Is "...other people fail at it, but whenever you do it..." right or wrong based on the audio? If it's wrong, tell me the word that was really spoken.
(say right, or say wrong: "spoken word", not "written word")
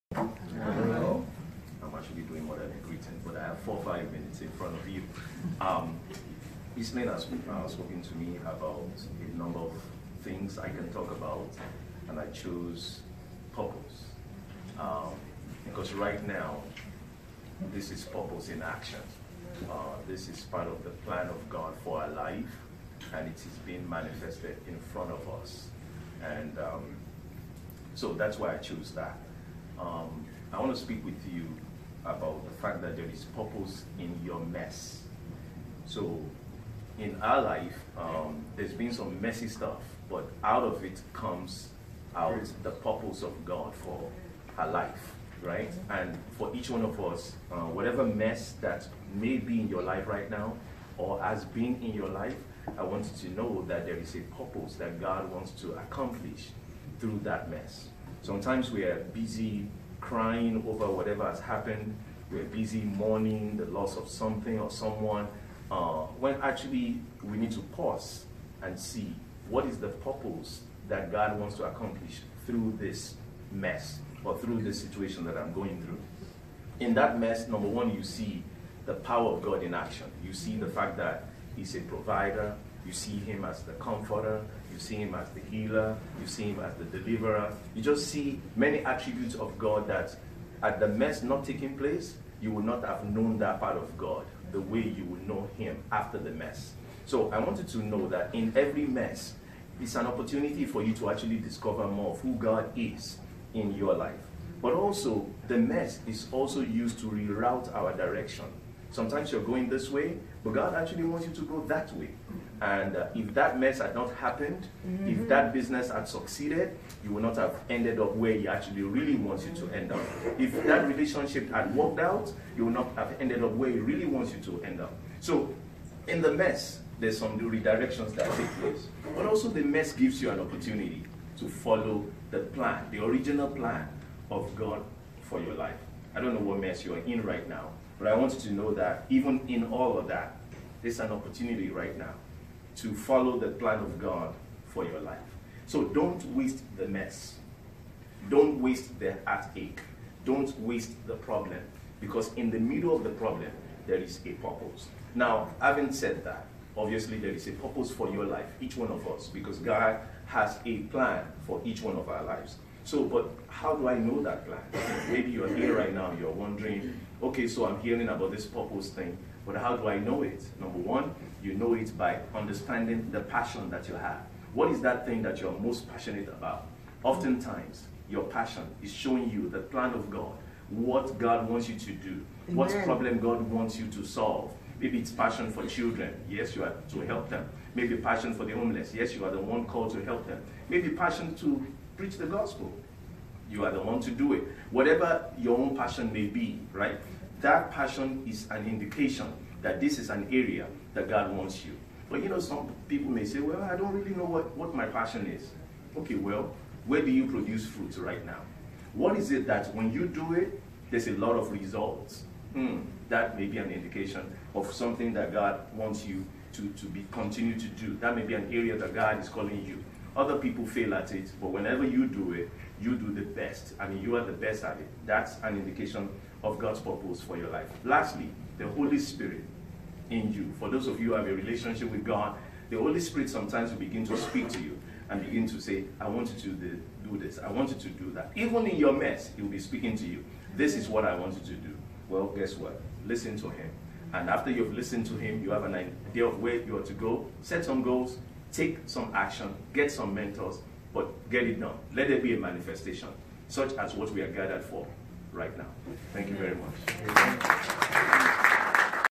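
right.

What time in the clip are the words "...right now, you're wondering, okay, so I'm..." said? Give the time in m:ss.
2:45.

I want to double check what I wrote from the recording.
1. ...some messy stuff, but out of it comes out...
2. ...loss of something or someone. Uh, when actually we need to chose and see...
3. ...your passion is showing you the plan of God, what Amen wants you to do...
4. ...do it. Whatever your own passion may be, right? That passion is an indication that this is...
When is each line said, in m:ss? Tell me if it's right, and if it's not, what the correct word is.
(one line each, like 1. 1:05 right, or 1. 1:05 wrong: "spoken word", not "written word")
1. 0:38 right
2. 1:03 wrong: "pause", not "chose"
3. 2:58 wrong: "God", not "Amen"
4. 3:14 right.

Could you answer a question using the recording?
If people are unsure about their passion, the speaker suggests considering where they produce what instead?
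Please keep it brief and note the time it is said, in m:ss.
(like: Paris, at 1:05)
Fruits, at 3:27.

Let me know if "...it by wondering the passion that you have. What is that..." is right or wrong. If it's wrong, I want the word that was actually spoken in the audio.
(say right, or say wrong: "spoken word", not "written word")
wrong: "understanding", not "wondering".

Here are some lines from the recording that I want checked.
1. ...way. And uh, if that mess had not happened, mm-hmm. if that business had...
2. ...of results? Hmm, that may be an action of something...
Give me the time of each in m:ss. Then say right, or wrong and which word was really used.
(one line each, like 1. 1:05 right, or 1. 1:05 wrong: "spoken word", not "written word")
1. 1:51 right
2. 3:31 wrong: "indication", not "action".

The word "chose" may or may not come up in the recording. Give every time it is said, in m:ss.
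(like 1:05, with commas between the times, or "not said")
0:12, 0:28.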